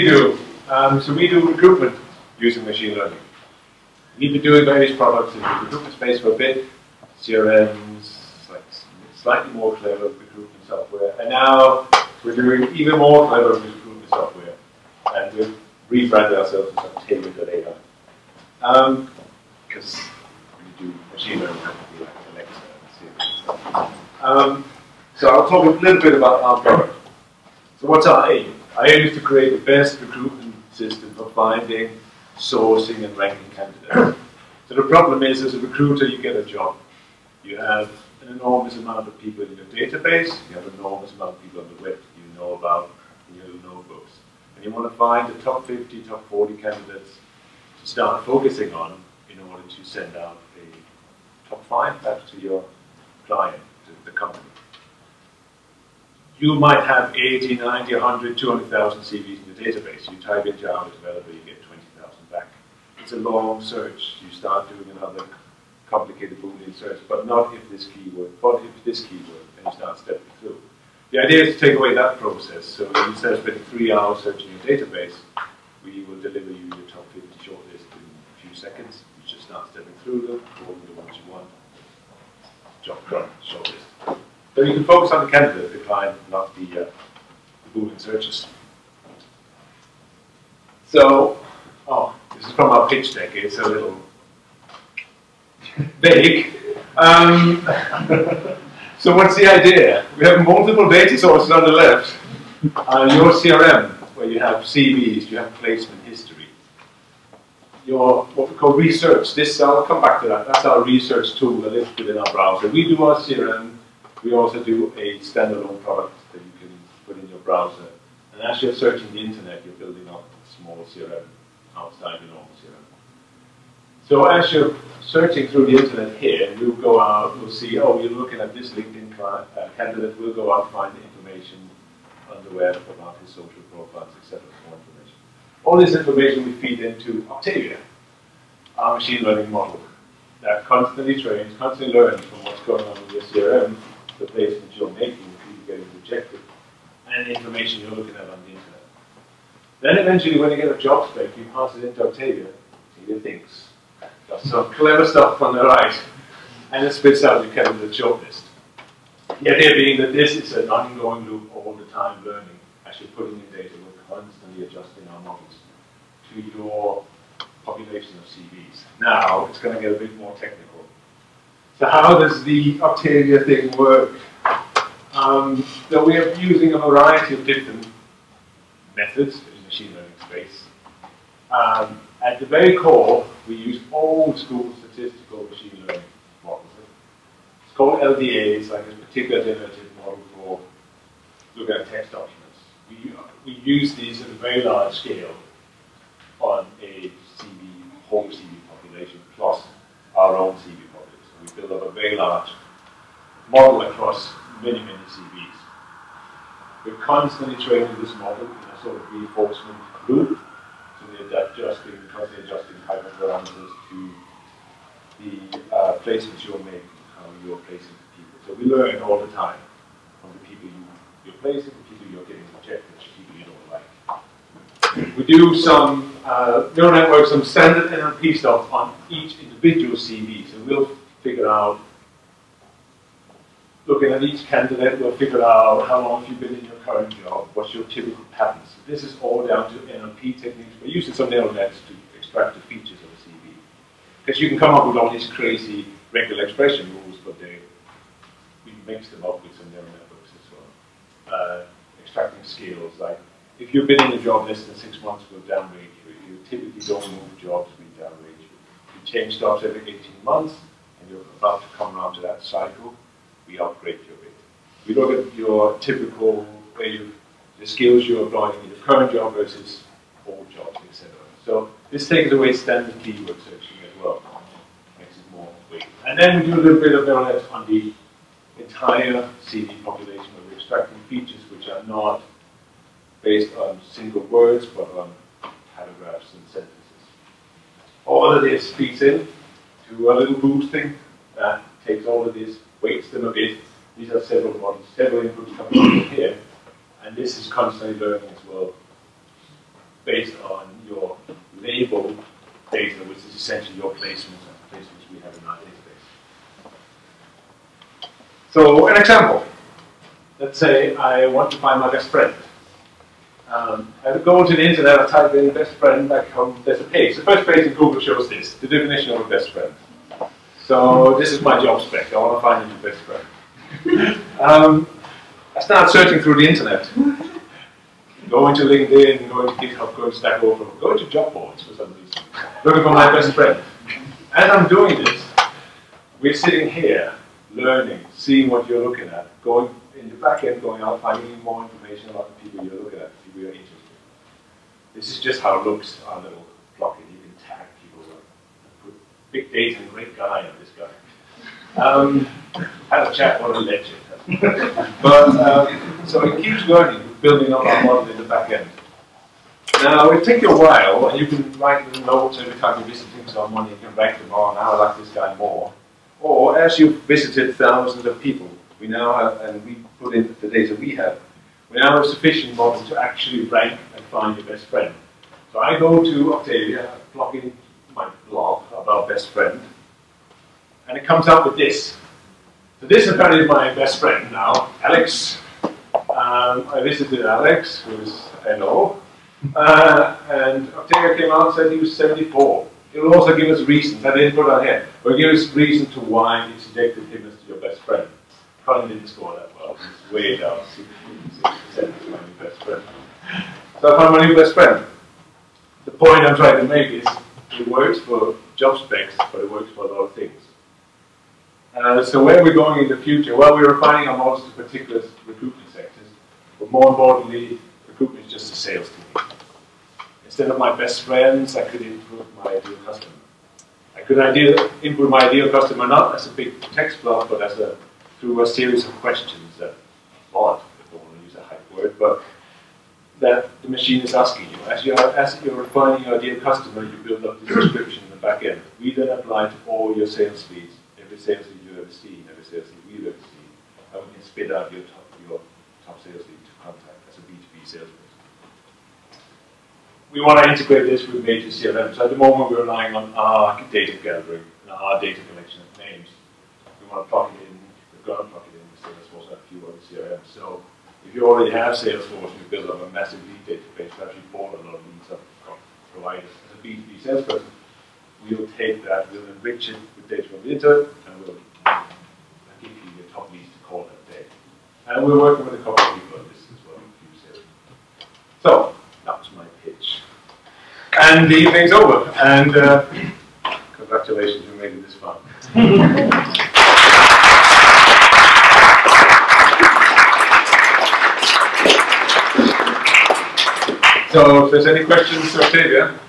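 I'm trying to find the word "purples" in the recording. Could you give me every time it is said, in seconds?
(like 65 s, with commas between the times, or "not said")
not said.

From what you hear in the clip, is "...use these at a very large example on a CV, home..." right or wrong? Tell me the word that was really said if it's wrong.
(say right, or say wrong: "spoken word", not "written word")
wrong: "scale", not "example".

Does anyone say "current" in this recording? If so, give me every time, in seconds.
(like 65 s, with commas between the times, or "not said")
236 s, 268 s.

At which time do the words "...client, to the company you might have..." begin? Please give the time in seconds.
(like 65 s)
53 s.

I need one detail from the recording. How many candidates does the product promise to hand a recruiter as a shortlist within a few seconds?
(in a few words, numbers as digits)
50.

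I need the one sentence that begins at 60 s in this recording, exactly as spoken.
You type in Java developer, you get 20,000 back.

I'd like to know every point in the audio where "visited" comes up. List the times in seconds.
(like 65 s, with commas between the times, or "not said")
367 s, 386 s.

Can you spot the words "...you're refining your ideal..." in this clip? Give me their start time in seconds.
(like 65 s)
435 s.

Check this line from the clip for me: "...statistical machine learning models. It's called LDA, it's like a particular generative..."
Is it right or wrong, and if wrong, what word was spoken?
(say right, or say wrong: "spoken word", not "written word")
right.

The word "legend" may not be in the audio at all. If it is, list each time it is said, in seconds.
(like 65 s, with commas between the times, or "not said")
353 s.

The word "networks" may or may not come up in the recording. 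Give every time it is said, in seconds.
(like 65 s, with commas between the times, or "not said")
226 s, 249 s.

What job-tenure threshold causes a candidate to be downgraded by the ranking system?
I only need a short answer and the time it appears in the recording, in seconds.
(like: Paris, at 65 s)
less than six months, at 254 s.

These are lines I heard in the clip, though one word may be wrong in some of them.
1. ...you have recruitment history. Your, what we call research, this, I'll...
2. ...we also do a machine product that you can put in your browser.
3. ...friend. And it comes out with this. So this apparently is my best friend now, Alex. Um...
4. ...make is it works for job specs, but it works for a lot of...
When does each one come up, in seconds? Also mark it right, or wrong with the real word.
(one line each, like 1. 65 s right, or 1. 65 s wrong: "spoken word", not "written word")
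1. 105 s wrong: "placement", not "recruitment"
2. 114 s wrong: "standalone", not "machine"
3. 379 s right
4. 406 s right.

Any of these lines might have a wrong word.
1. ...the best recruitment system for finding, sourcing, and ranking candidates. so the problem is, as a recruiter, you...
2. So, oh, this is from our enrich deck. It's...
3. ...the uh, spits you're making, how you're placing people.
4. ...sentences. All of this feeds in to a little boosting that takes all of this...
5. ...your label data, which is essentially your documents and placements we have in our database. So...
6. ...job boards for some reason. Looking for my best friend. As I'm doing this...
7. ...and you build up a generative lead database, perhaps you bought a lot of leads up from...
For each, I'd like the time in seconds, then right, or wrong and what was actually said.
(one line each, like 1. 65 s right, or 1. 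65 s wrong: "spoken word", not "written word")
1. 29 s right
2. 90 s wrong: "pitch", not "enrich"
3. 215 s wrong: "placements", not "spits"
4. 286 s right
5. 300 s wrong: "placements", not "documents"
6. 331 s right
7. 462 s wrong: "massive", not "generative".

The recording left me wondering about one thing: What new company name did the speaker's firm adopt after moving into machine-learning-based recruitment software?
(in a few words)
tailored AI.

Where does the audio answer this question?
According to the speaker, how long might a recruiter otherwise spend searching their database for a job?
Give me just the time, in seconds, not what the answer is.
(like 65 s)
73 s.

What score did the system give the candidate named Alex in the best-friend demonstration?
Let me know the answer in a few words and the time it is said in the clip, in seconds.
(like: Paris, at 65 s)
74, at 391 s.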